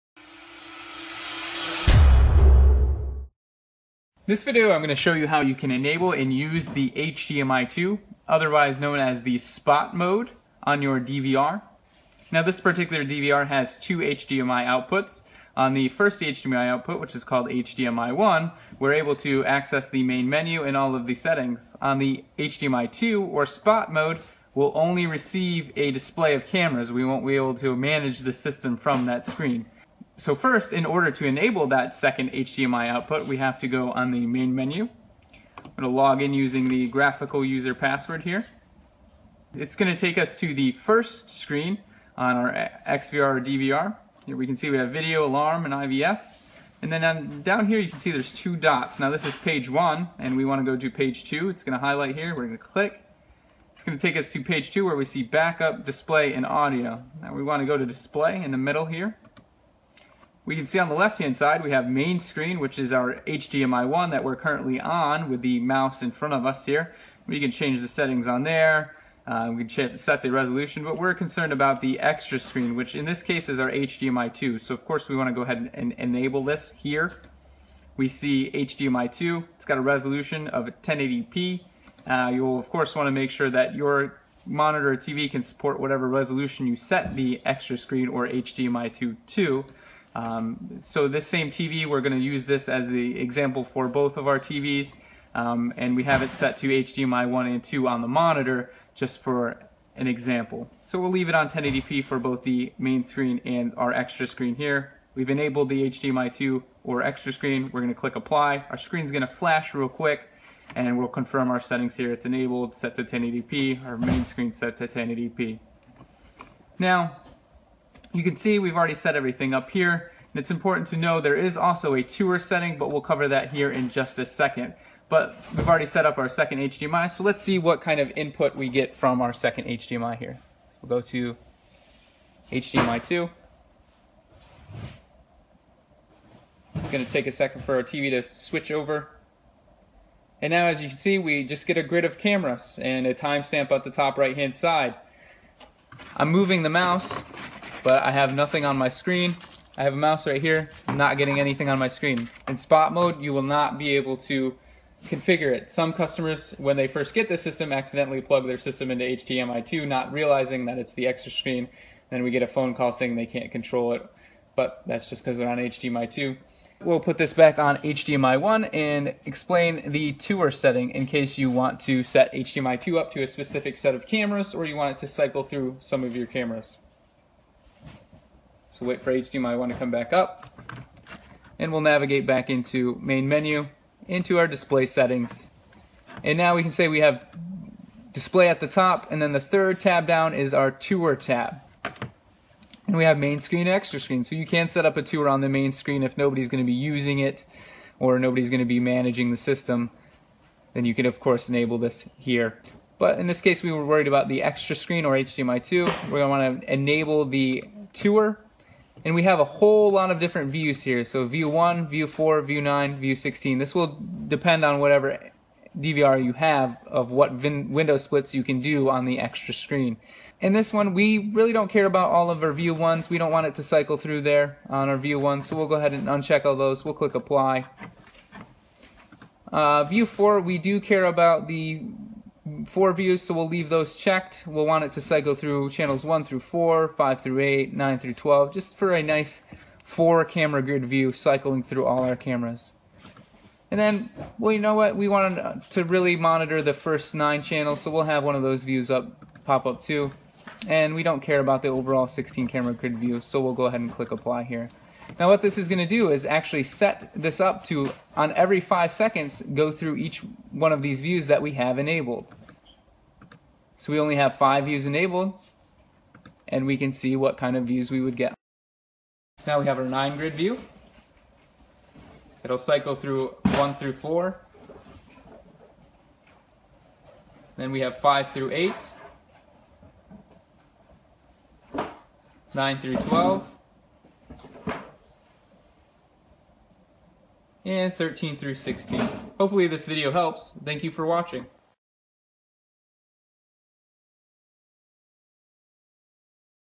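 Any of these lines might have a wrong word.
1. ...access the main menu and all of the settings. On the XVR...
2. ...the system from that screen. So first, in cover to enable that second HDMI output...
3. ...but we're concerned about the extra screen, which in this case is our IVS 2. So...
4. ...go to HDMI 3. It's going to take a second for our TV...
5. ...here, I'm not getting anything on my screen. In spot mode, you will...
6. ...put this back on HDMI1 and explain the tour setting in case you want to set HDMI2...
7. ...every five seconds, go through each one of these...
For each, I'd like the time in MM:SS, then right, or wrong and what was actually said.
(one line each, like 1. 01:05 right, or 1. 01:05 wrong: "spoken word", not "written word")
1. 00:19 wrong: "HDMI", not "XVR"
2. 00:28 wrong: "order", not "cover"
3. 01:10 wrong: "HDMI", not "IVS"
4. 02:10 wrong: "2", not "3"
5. 02:30 right
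6. 02:46 right
7. 04:18 right.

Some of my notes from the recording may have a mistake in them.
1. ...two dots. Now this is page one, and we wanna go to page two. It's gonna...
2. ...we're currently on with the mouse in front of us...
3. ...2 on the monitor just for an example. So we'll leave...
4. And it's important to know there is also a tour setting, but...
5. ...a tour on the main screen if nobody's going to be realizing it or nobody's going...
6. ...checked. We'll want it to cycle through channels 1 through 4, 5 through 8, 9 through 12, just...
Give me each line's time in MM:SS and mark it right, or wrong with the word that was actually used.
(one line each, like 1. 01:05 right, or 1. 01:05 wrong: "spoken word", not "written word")
1. 00:48 right
2. 01:04 right
3. 01:37 right
4. 02:00 right
5. 03:14 wrong: "using", not "realizing"
6. 03:53 right.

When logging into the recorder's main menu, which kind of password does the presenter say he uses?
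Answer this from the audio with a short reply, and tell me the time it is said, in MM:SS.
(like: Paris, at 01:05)
graphical user password, at 00:36.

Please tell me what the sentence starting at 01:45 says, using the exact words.
We've enabled the HDMI 2 or extra screen.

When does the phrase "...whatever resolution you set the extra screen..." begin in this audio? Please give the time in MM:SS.
01:25.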